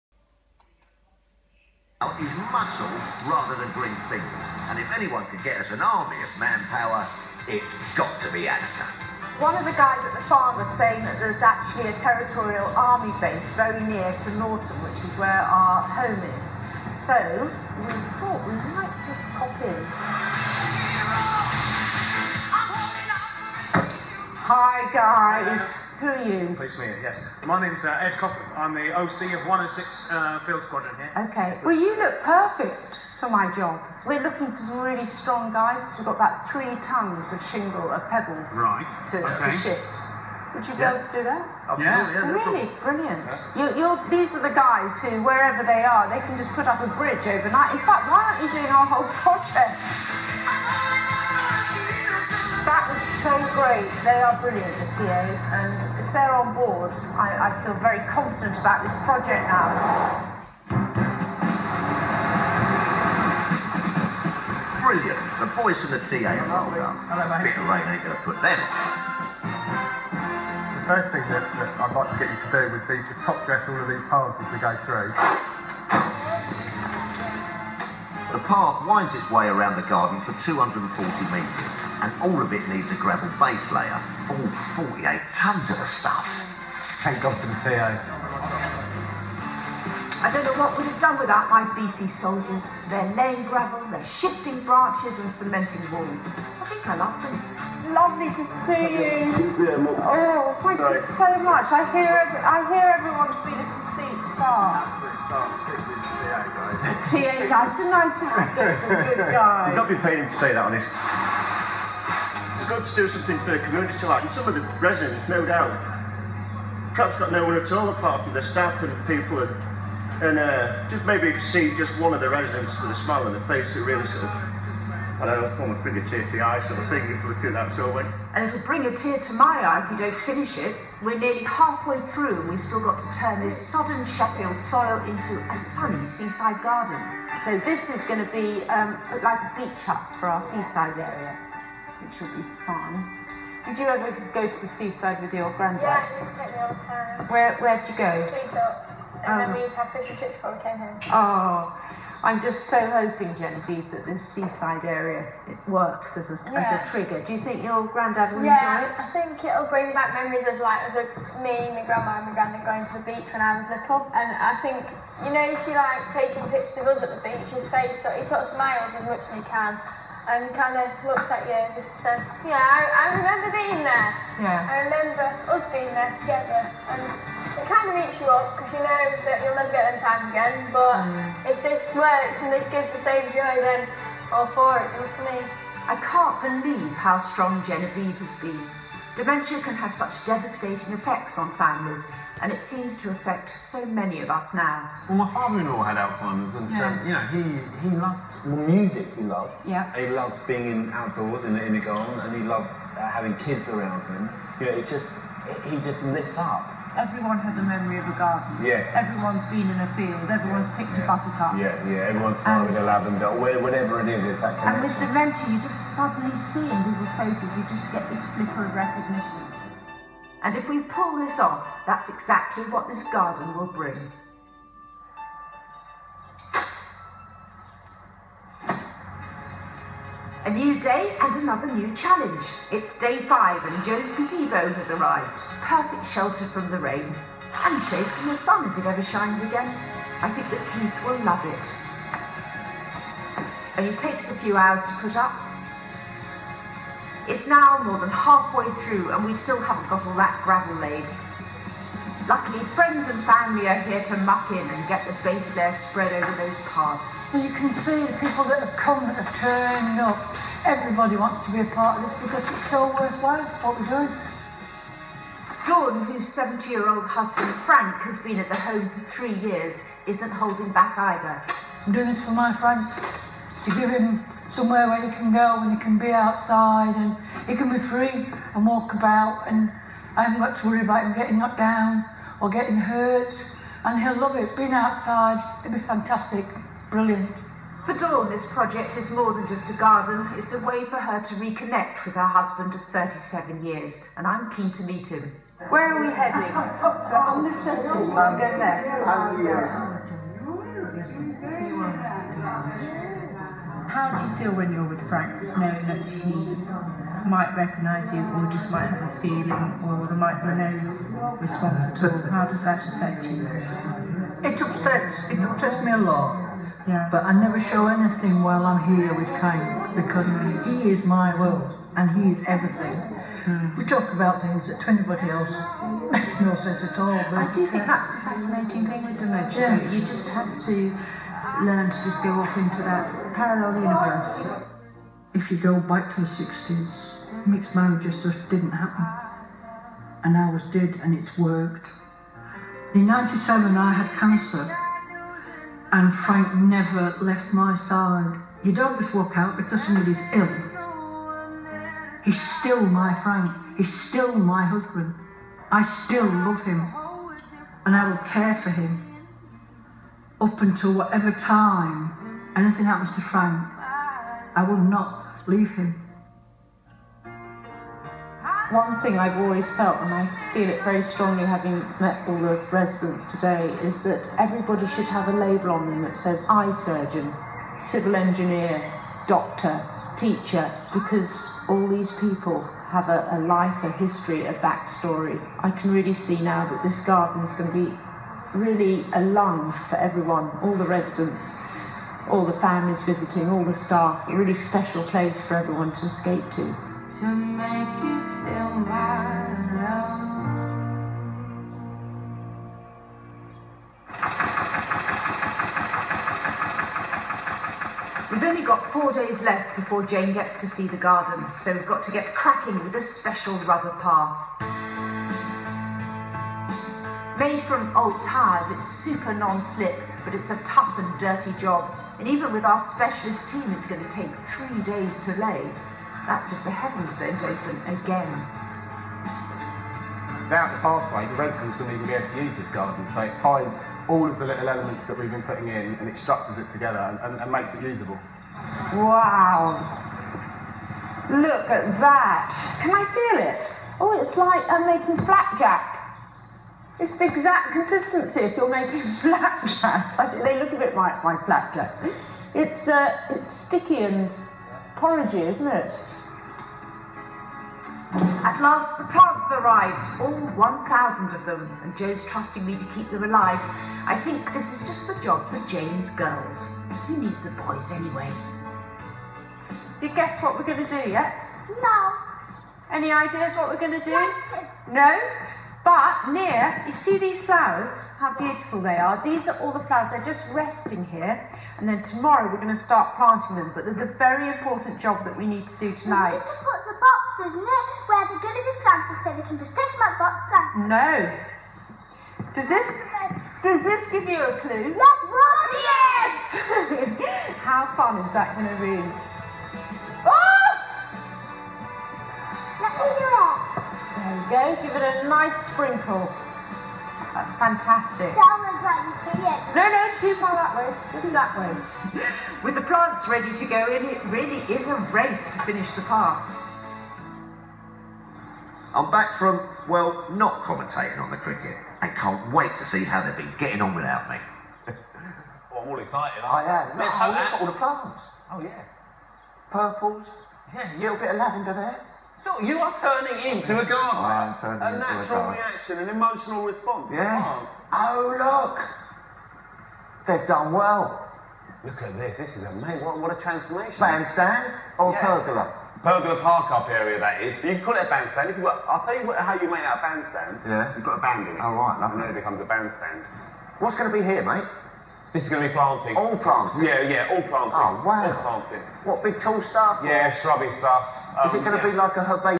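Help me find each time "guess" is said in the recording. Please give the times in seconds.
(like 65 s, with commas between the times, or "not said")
470 s.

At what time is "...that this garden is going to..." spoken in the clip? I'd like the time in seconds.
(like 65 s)
386 s.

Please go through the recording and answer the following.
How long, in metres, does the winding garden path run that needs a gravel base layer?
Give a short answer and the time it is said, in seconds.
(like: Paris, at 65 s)
240, at 80 s.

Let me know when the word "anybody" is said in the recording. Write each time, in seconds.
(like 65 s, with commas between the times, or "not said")
324 s.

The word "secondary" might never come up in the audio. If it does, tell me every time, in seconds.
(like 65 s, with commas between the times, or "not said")
not said.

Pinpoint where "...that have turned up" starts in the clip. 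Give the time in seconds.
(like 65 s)
259 s.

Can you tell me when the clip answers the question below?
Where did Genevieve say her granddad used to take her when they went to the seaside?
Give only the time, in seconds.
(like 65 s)
148 s.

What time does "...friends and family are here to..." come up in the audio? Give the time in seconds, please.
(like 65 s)
252 s.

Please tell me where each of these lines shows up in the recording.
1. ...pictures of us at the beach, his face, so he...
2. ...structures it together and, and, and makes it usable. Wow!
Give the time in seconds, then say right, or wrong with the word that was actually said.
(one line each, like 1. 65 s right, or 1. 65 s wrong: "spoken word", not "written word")
1. 166 s right
2. 436 s right.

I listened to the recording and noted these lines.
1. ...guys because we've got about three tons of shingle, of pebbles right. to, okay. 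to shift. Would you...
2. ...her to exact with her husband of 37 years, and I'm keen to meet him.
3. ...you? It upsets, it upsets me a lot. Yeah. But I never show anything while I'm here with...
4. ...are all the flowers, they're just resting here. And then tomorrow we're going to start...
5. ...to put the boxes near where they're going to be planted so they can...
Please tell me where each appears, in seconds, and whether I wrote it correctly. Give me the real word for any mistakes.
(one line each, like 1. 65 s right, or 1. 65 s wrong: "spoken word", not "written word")
1. 35 s right
2. 290 s wrong: "reconnect", not "exact"
3. 313 s right
4. 479 s right
5. 486 s right.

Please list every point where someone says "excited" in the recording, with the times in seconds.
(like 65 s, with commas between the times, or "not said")
525 s.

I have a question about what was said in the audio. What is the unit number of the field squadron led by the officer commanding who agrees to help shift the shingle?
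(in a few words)
106.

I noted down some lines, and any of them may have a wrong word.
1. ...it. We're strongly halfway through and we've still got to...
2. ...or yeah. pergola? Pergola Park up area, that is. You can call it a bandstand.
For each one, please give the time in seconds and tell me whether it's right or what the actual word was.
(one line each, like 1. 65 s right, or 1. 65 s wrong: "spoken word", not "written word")
1. 130 s wrong: "nearly", not "strongly"
2. 544 s right.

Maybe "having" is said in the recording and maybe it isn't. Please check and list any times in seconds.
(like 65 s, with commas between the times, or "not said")
203 s, 371 s.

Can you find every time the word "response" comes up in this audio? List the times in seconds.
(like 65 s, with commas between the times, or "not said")
311 s, 536 s.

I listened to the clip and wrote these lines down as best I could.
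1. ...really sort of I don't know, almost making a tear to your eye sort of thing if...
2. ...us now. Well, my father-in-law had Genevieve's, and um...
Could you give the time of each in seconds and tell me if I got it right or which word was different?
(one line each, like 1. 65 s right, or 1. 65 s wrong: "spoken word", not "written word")
1. 123 s wrong: "bring", not "making"
2. 194 s wrong: "Alzheimer", not "Genevieve".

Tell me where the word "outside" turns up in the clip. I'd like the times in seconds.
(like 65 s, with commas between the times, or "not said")
276 s, 284 s.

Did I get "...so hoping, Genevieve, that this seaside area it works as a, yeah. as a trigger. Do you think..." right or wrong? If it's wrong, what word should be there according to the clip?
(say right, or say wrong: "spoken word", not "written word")
right.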